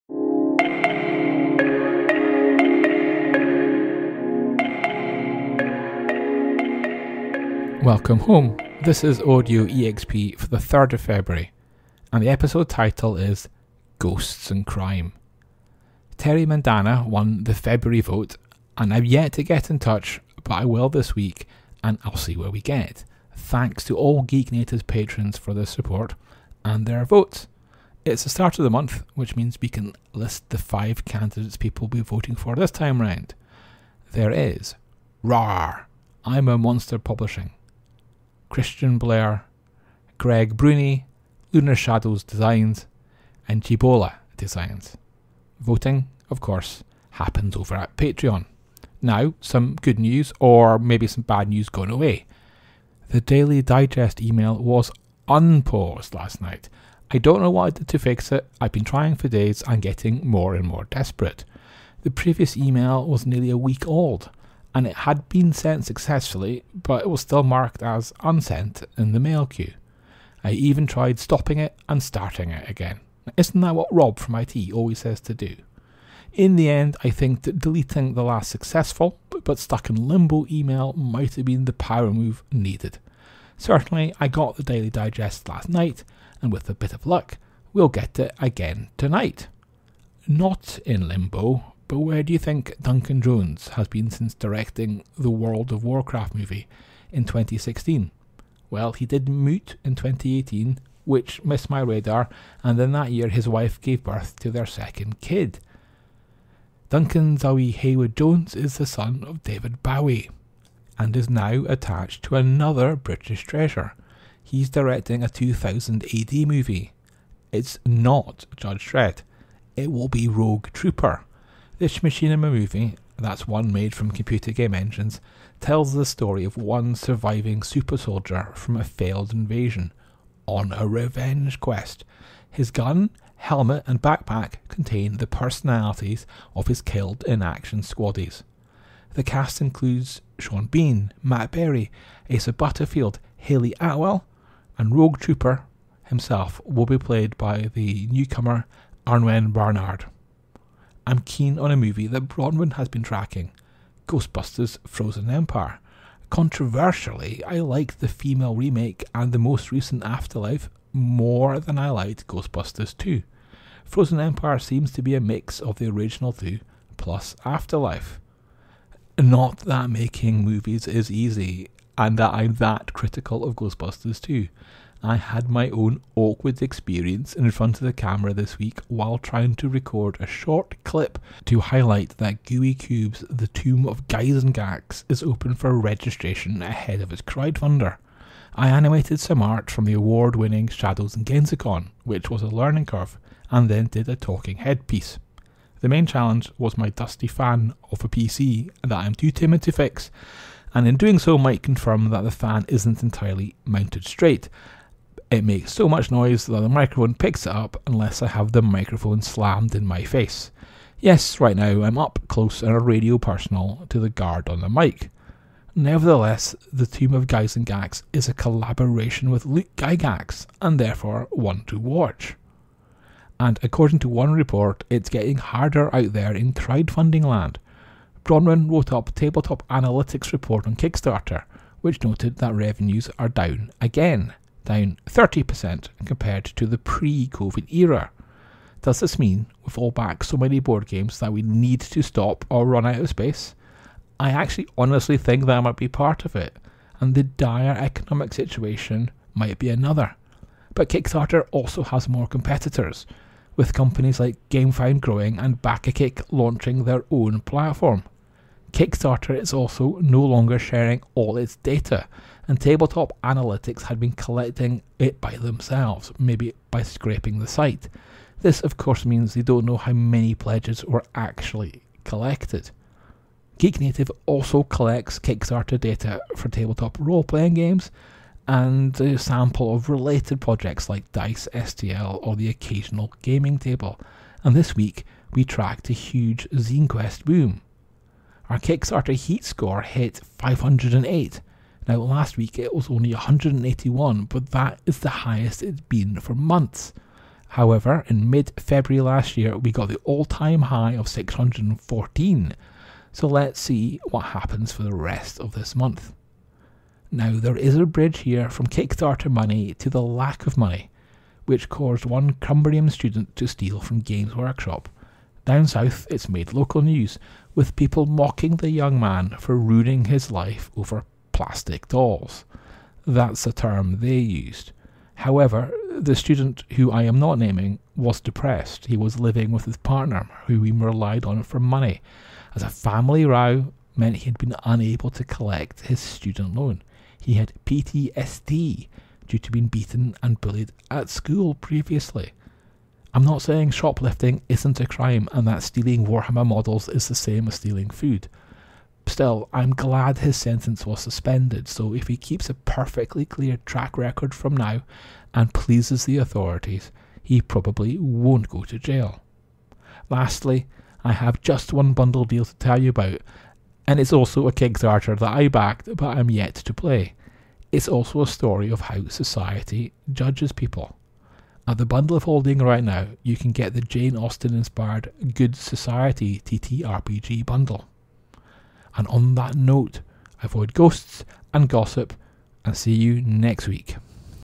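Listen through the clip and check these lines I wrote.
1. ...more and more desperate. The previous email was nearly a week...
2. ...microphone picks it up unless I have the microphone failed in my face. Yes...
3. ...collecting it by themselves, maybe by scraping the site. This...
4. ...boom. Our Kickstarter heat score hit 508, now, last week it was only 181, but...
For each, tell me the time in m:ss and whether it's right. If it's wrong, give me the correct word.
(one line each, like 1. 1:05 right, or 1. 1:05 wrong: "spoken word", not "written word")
1. 1:00 right
2. 3:26 wrong: "slammed", not "failed"
3. 4:24 right
4. 4:47 right.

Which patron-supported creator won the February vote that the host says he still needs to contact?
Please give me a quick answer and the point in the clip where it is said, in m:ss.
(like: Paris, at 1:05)
Terry Mandana, at 0:16.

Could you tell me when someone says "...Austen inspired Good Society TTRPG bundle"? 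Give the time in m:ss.
6:14.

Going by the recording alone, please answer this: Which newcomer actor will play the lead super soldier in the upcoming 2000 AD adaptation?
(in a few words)
Aneurin Barnard.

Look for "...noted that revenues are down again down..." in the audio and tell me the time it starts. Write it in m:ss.
3:52.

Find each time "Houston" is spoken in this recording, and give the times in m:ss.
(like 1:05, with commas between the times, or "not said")
not said.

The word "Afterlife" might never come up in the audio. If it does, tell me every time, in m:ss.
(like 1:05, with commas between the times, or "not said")
2:40, 2:47.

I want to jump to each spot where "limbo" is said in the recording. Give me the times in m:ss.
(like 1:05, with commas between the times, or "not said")
1:20, 1:31.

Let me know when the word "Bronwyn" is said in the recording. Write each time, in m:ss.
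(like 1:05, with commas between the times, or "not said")
2:32, 3:48.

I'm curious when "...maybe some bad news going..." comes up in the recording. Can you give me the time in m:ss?
0:50.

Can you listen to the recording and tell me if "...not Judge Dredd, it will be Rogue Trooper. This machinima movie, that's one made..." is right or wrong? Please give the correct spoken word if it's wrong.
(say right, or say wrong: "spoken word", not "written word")
right.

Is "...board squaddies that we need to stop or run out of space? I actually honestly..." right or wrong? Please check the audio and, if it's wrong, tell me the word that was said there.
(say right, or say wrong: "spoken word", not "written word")
wrong: "games", not "squaddies".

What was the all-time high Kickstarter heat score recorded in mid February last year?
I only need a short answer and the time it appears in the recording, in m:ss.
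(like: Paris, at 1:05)
614, at 5:01.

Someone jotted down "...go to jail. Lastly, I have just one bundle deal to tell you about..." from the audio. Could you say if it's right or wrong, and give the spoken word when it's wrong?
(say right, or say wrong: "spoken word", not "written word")
right.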